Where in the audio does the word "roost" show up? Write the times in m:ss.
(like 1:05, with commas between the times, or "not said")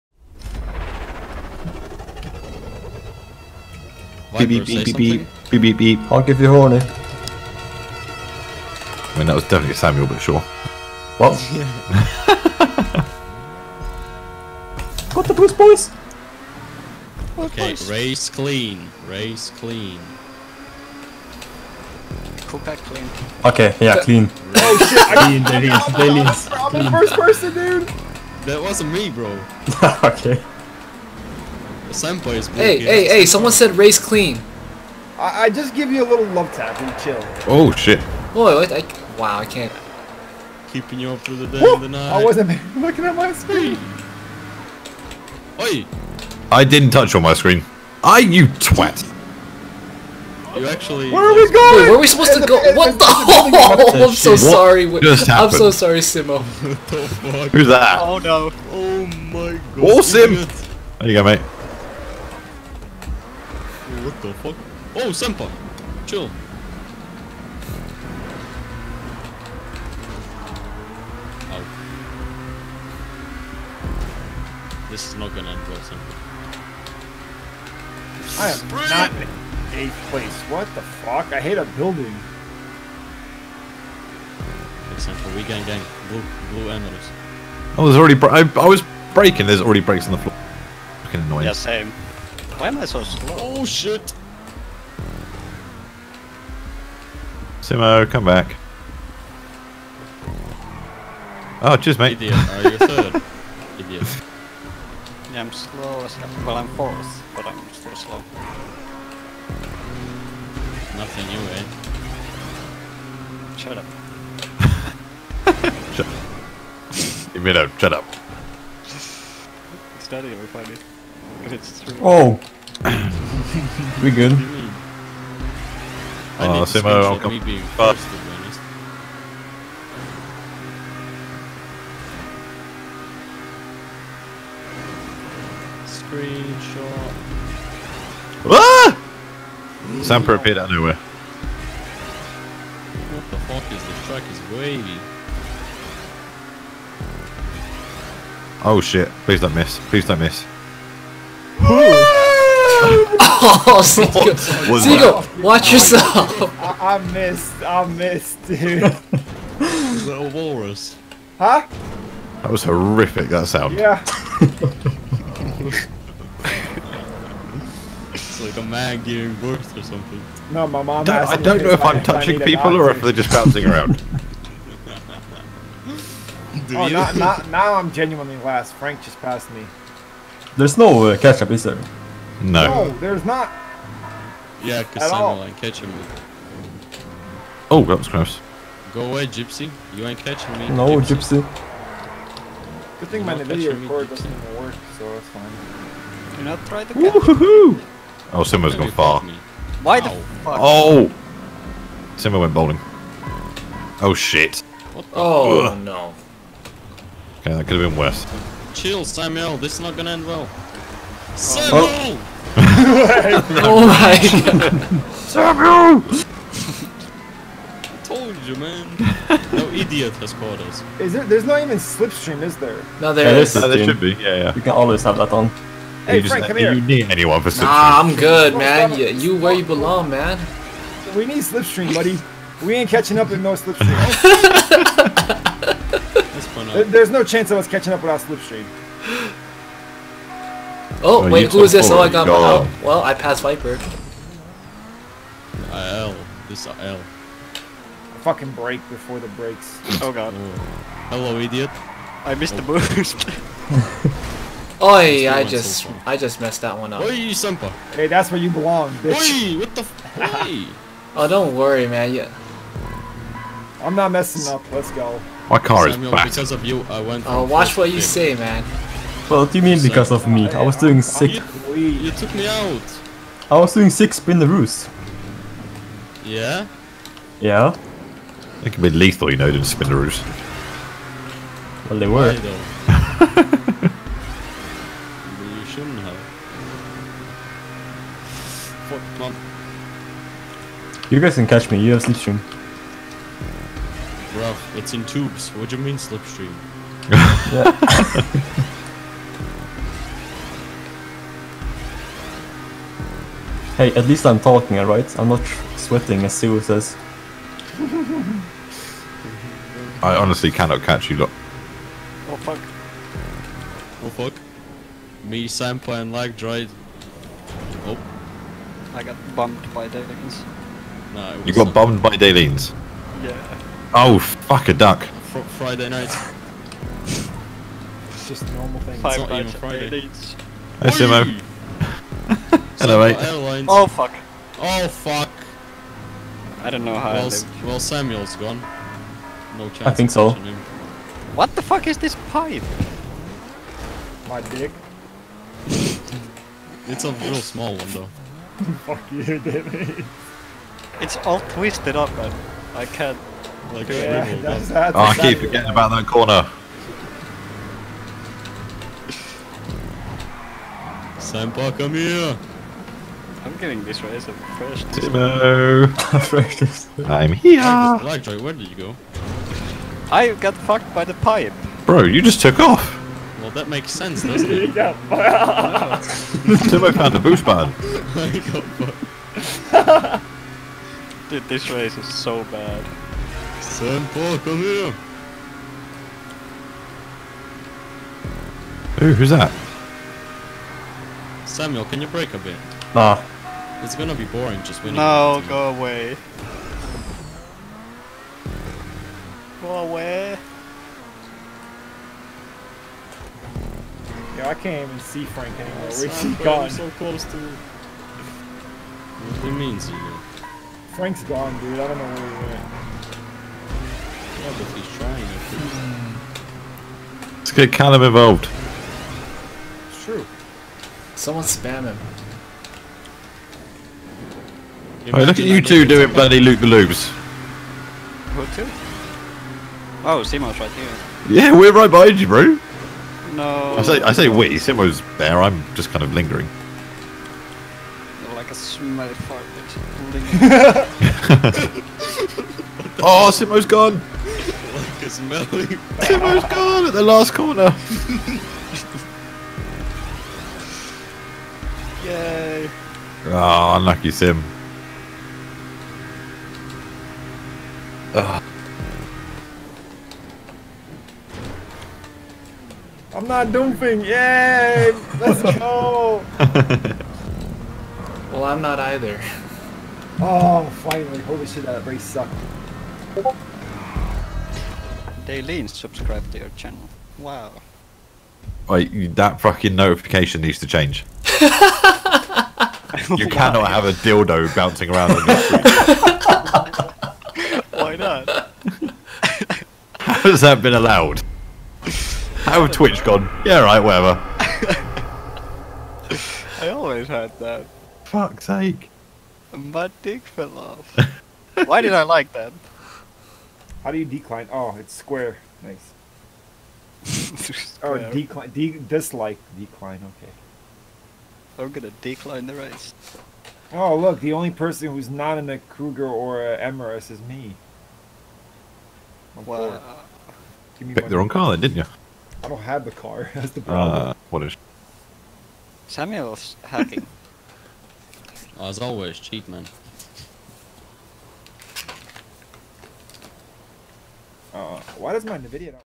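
4:34, 4:39.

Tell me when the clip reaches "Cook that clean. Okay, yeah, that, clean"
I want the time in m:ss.
0:22.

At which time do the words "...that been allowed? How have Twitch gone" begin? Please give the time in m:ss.
8:10.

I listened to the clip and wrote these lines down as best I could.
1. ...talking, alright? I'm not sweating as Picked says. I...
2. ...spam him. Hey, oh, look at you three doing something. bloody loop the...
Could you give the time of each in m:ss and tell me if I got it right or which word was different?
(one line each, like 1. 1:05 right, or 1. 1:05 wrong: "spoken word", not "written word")
1. 5:04 wrong: "Sue", not "Picked"
2. 7:01 wrong: "two", not "three".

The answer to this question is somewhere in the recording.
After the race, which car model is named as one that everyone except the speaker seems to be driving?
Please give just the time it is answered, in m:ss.
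8:35.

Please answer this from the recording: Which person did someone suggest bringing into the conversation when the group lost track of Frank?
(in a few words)
Callum.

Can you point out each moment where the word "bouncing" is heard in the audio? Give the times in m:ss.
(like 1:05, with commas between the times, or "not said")
2:53, 8:04.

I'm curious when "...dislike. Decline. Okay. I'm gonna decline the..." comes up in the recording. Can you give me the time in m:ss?
8:28.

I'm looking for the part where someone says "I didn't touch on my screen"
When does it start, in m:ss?
0:46.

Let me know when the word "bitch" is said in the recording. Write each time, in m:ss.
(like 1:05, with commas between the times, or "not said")
4:18.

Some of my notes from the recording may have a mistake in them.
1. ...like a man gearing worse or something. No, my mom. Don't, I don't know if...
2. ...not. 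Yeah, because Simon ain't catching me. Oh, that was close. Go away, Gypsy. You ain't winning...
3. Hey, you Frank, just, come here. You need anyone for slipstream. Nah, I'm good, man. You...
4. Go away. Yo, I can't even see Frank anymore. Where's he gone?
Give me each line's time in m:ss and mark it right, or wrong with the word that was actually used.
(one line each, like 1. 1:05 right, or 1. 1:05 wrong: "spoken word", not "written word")
1. 2:48 right
2. 3:03 wrong: "catching", not "winning"
3. 3:46 right
4. 6:39 right.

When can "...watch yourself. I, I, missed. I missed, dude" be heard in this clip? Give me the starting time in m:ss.
2:35.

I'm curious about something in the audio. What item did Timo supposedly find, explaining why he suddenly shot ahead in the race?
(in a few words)
boost pad.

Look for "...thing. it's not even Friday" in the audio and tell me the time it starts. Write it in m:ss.
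5:28.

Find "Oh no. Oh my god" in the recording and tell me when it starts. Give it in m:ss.
0:58.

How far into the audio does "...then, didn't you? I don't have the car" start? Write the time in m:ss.
8:41.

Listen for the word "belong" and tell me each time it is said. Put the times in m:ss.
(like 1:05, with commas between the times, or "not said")
3:49, 4:18.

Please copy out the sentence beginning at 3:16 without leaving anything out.
Do not try to oh, catch Woohoo!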